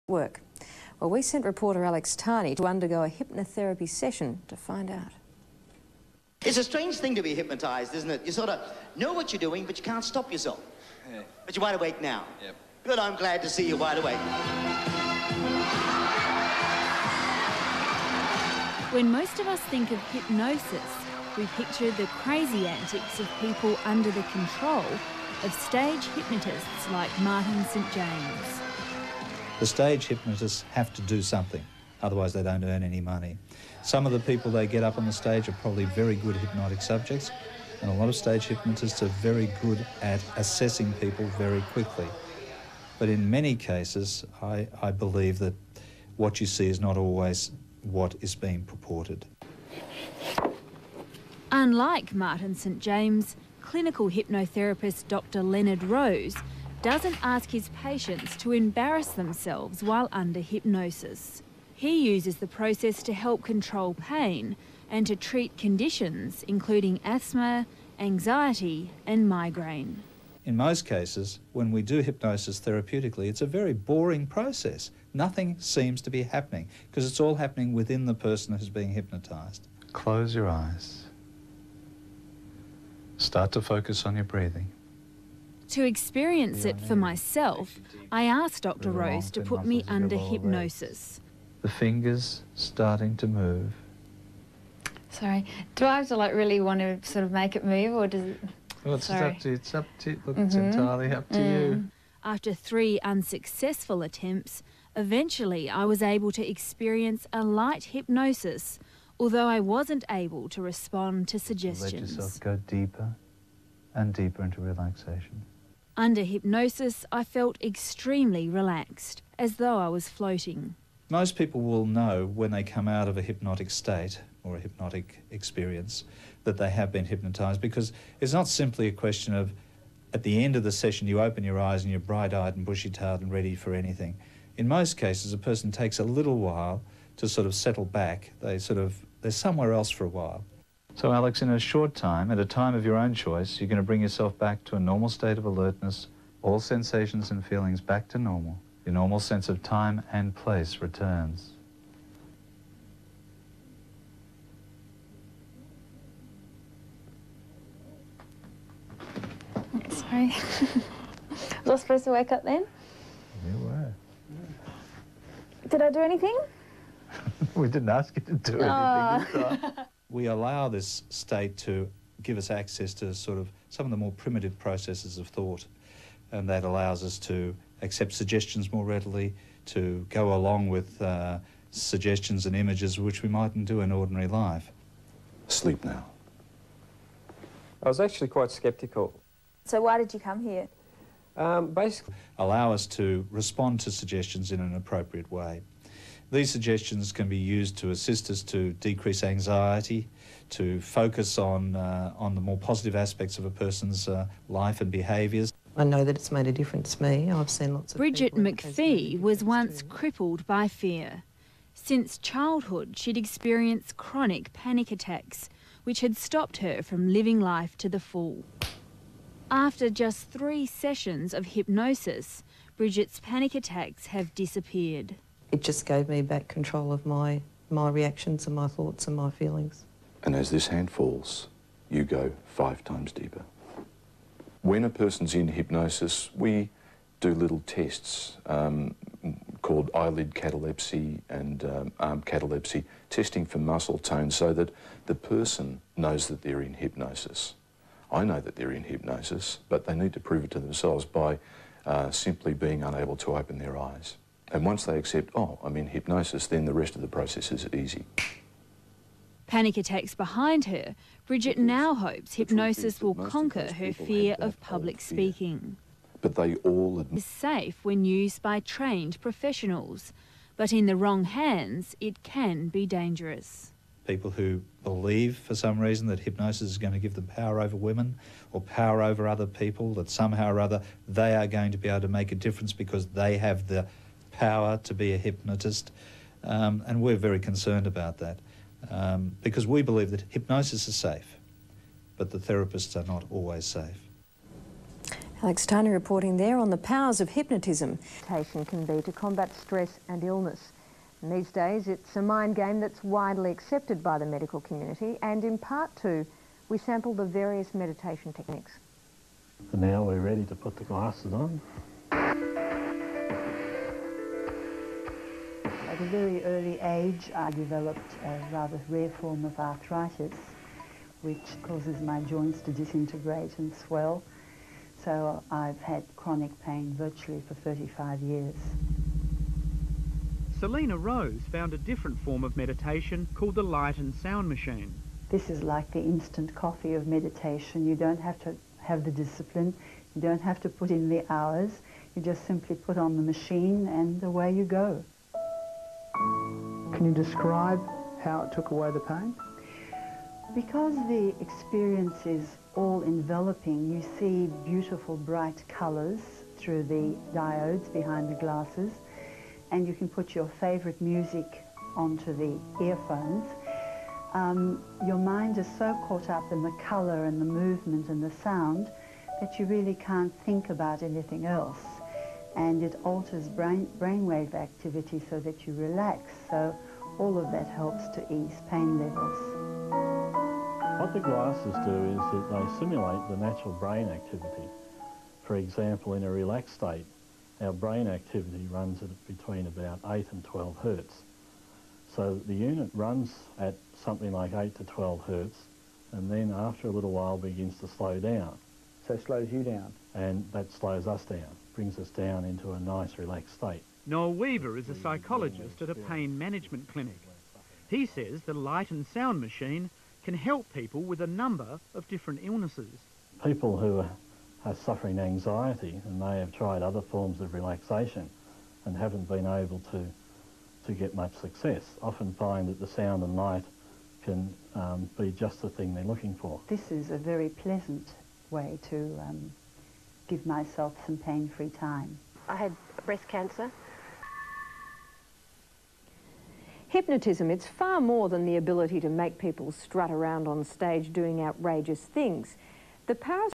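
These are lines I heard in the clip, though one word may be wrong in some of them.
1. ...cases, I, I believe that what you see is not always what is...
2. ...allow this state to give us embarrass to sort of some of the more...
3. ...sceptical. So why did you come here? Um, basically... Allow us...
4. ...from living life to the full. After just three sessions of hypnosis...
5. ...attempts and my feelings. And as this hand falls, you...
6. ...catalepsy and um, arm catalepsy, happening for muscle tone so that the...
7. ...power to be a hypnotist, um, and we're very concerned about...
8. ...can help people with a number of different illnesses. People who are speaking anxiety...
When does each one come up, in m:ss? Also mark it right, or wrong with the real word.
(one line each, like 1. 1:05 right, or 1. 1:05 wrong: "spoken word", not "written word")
1. 0:43 right
2. 2:50 wrong: "access", not "embarrass"
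3. 3:08 right
4. 3:36 right
5. 3:48 wrong: "thoughts", not "attempts"
6. 4:00 wrong: "testing", not "happening"
7. 4:44 right
8. 6:50 wrong: "suffering", not "speaking".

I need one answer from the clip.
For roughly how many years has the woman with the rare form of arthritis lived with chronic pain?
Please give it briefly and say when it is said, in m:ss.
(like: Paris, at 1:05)
35, at 5:27.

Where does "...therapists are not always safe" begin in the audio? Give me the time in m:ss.
4:52.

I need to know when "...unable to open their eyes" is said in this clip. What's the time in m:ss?
4:12.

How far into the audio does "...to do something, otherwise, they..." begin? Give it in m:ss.
0:30.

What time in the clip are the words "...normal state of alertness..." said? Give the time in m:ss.
2:24.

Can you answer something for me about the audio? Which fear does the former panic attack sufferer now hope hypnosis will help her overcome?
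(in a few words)
public speaking.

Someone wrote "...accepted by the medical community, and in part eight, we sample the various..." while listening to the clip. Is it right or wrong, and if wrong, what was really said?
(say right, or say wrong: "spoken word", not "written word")
wrong: "two", not "eight".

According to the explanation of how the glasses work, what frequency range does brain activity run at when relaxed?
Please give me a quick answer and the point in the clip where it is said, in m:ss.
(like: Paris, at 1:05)
8 to 12 hertz, at 6:30.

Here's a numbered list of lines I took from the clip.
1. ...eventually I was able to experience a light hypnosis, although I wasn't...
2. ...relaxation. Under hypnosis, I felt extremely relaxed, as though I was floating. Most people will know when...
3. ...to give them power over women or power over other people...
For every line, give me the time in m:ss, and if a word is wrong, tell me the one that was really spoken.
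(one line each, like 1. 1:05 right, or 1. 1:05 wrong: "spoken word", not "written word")
1. 1:44 right
2. 1:54 right
3. 4:36 right.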